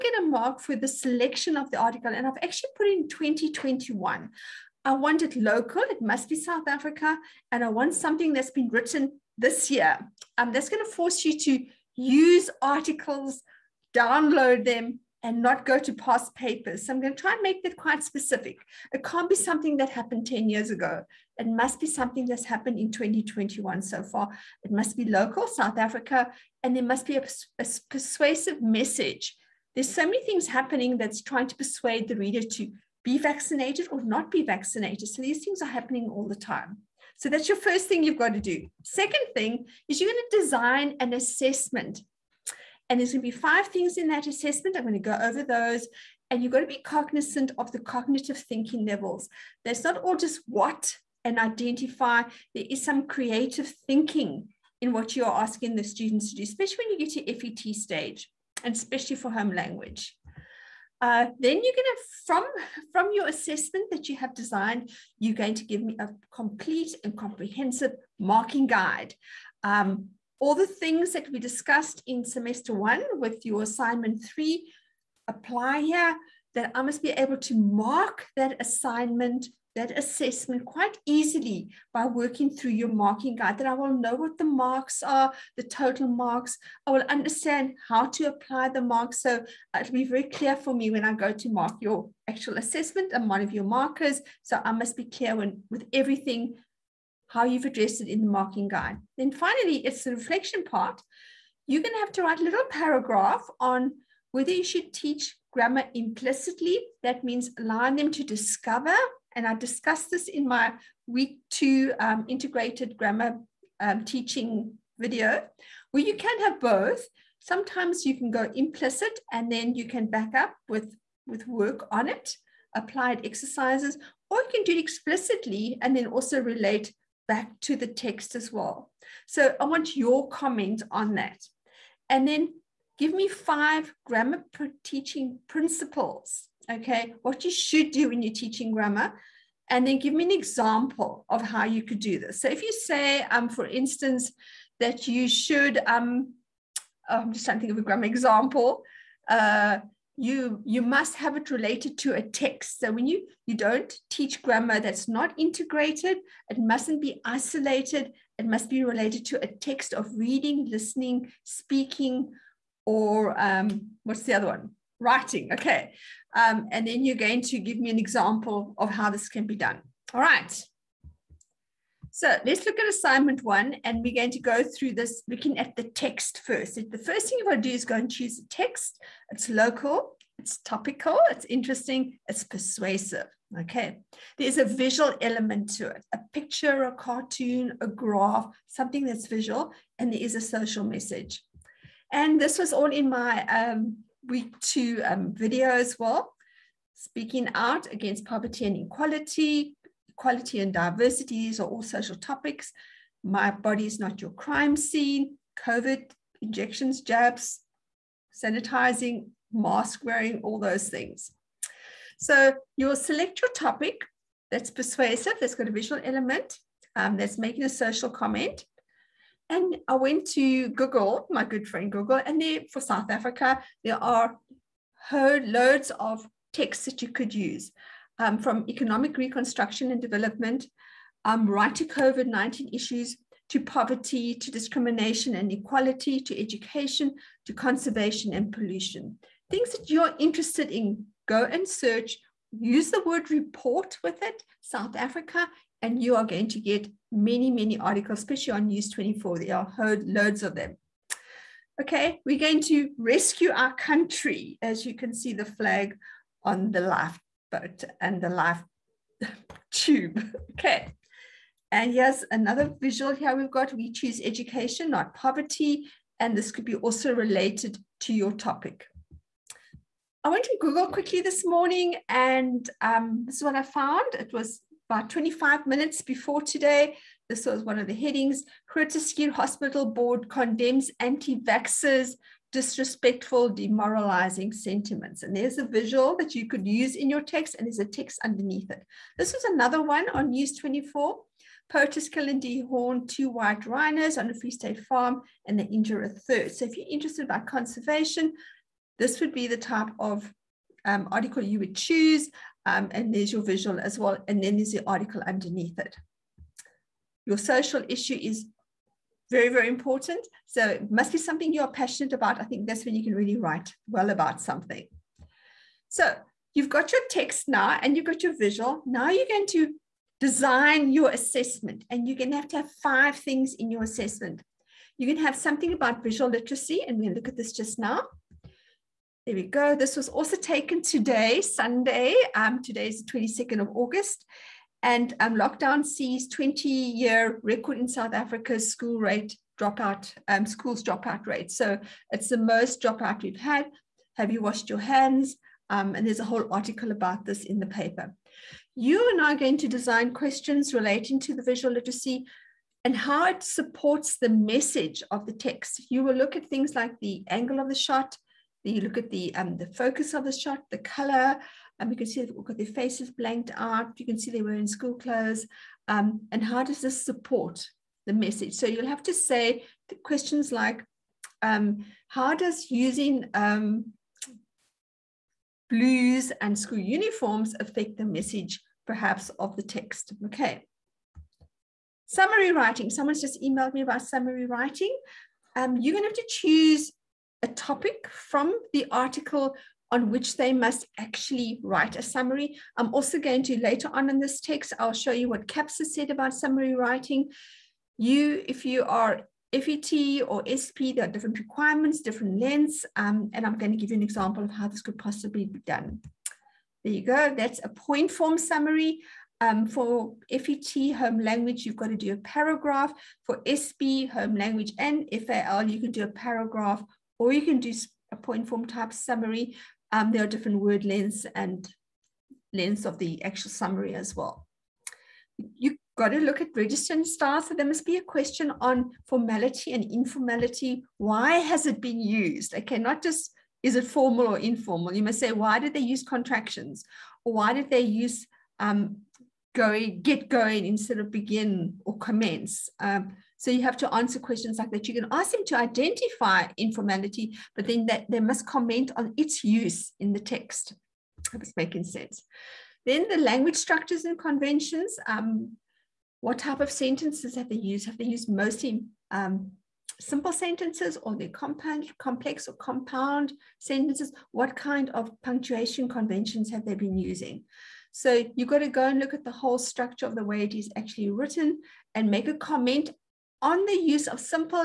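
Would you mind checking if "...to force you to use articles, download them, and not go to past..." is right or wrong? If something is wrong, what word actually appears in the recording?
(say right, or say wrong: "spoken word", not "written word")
right.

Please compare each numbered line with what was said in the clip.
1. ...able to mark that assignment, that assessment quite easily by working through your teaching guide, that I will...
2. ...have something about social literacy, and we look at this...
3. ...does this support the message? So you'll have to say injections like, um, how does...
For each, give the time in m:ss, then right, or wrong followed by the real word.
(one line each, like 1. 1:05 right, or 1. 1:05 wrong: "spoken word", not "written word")
1. 1:17 wrong: "marking", not "teaching"
2. 5:25 wrong: "visual", not "social"
3. 6:06 wrong: "questions", not "injections".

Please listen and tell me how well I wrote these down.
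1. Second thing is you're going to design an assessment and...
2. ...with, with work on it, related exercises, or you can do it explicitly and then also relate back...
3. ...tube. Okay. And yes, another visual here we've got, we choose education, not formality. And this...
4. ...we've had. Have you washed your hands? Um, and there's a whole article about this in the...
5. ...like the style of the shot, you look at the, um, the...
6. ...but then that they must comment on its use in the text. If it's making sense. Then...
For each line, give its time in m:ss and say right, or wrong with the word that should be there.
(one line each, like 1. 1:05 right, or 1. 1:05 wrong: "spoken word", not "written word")
1. 0:38 right
2. 2:00 wrong: "applied", not "related"
3. 4:19 wrong: "poverty", not "formality"
4. 5:43 right
5. 5:56 wrong: "angle", not "style"
6. 7:27 right.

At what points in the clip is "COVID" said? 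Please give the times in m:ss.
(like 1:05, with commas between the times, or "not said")
3:25, 3:51.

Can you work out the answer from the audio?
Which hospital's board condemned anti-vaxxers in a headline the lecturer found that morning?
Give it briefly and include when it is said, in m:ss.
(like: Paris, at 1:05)
Groote Schuur Hospital, at 4:38.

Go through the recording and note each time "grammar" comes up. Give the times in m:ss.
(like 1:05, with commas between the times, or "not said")
1:45, 1:52, 2:14, 2:18, 2:27, 2:34.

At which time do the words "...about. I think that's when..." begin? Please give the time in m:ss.
5:12.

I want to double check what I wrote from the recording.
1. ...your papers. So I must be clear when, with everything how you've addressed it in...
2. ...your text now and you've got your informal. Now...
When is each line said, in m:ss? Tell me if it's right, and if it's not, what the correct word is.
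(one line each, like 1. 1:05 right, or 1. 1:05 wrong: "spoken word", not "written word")
1. 1:33 wrong: "markers", not "papers"
2. 5:16 wrong: "visual", not "informal".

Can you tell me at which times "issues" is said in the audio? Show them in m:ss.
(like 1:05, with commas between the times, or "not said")
3:52, 5:07.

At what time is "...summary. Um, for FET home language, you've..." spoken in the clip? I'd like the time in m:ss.
6:48.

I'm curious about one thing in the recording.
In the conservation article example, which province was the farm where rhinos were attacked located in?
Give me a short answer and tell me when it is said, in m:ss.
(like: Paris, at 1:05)
Free State, at 4:54.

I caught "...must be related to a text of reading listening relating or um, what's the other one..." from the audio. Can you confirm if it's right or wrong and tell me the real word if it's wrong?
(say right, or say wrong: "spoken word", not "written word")
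wrong: "speaking", not "relating".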